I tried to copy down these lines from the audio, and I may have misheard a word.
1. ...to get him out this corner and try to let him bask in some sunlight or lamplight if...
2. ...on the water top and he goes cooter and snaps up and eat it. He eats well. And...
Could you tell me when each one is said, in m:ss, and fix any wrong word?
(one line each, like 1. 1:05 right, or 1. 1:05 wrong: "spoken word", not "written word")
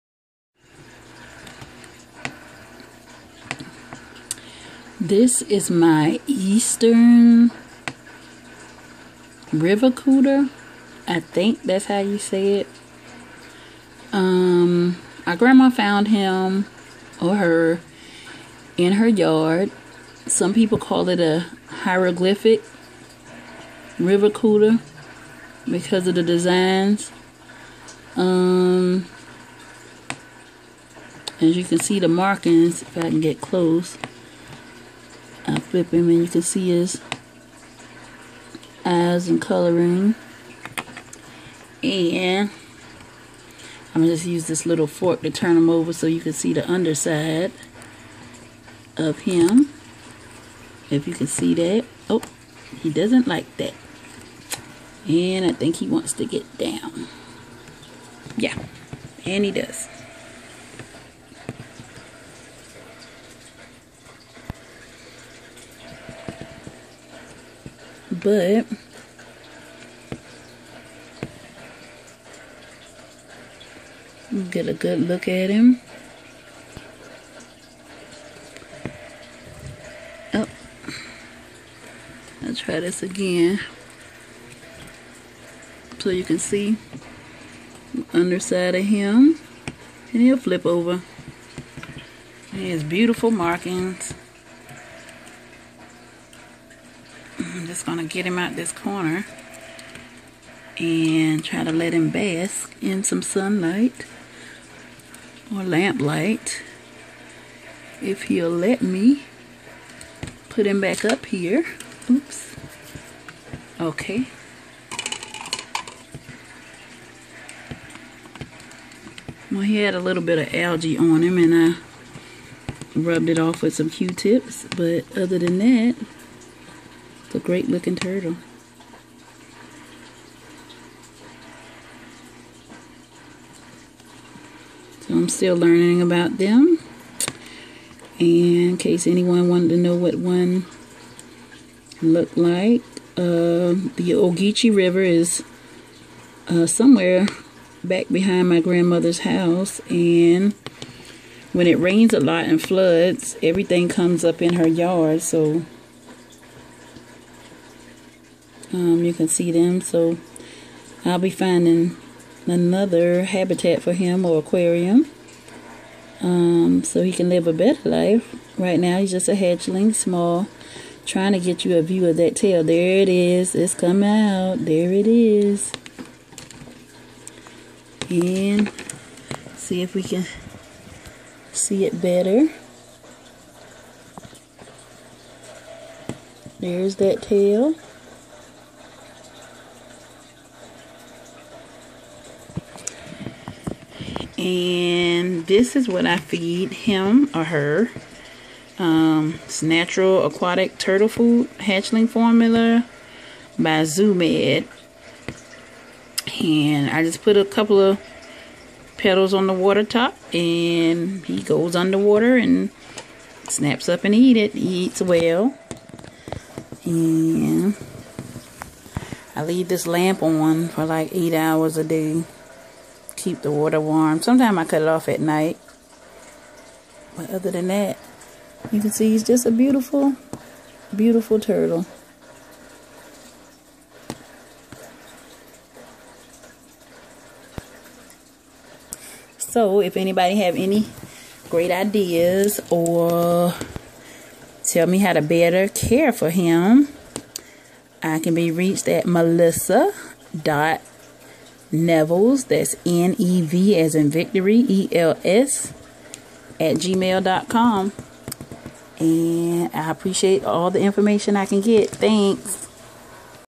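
1. 1:37 right
2. 3:29 wrong: "underwater", not "cooter".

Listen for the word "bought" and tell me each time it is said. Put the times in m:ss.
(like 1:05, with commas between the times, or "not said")
not said.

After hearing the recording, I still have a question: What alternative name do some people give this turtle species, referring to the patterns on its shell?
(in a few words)
Hieroglyphic river cooter.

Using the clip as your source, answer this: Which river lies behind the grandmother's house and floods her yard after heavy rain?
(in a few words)
Ogeechee River.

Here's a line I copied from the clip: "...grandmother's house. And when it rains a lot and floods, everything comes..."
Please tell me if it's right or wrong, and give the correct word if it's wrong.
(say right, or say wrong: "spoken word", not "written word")
right.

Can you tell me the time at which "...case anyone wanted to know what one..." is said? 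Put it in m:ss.
2:18.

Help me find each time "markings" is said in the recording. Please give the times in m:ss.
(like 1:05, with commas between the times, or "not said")
0:32, 1:33.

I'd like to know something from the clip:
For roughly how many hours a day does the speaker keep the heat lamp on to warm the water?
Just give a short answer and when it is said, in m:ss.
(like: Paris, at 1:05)
8, at 3:41.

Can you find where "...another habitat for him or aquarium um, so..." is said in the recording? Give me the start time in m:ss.
2:42.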